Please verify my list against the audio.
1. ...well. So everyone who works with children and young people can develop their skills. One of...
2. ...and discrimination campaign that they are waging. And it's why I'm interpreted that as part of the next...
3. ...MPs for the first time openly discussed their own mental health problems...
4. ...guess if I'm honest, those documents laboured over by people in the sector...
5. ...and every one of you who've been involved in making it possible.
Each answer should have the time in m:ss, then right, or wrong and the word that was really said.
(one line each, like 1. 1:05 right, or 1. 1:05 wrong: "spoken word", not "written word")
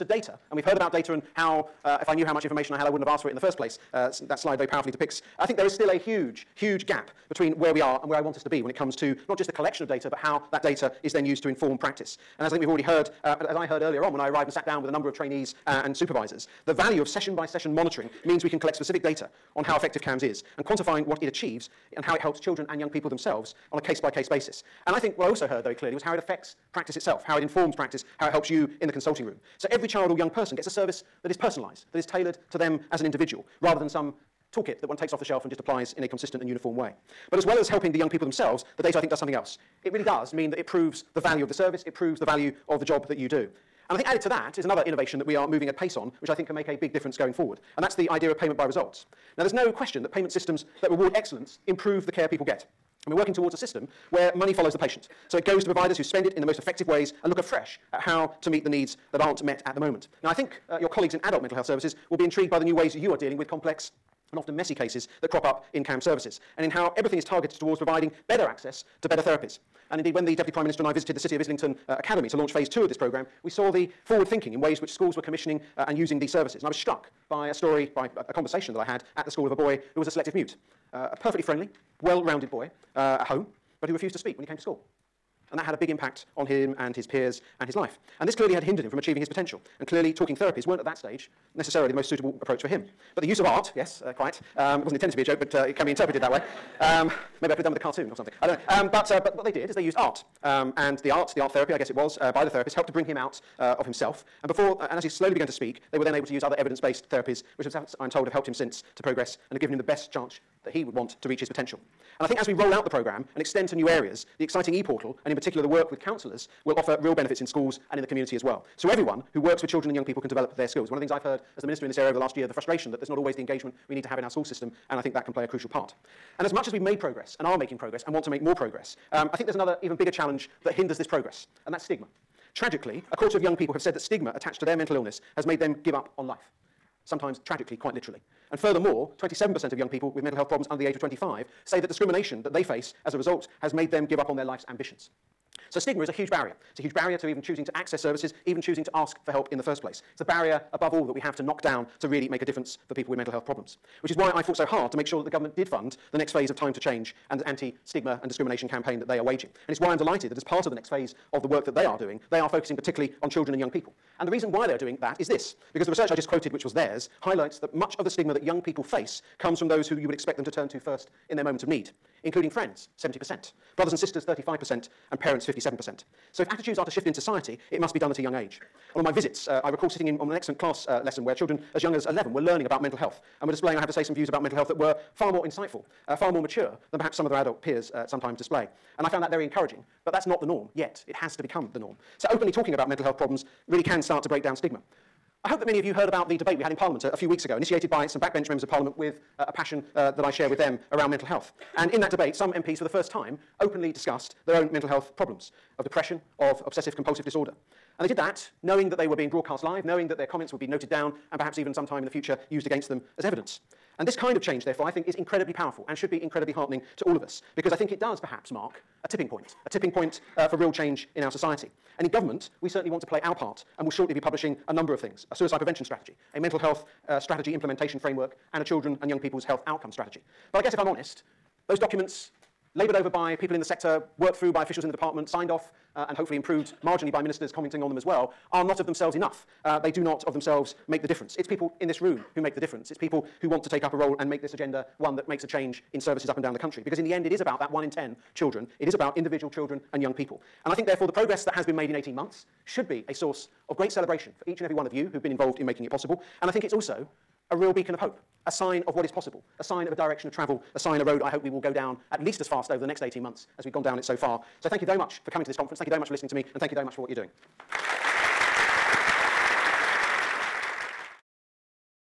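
1. 1:58 right
2. 2:38 wrong: "delighted", not "interpreted"
3. 3:22 right
4. 3:50 right
5. 4:14 right.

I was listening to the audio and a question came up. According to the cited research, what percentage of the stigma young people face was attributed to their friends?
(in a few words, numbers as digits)
70%.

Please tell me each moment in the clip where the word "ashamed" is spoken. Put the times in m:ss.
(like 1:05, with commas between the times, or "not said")
not said.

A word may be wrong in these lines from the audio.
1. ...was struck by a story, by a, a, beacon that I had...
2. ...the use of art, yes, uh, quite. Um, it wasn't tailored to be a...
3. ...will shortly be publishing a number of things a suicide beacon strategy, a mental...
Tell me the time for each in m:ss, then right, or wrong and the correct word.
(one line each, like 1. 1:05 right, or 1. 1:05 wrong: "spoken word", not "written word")
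1. 1:16 wrong: "conversation", not "beacon"
2. 1:33 wrong: "intended", not "tailored"
3. 3:43 wrong: "prevention", not "beacon".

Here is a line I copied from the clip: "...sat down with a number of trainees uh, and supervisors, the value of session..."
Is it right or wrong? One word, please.
right.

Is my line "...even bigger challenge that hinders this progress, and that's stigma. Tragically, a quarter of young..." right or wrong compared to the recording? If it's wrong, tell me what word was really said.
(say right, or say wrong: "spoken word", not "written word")
right.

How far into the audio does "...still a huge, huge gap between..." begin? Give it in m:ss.
0:05.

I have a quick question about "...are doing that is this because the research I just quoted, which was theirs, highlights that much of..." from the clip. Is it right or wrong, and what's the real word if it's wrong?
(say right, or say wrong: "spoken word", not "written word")
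right.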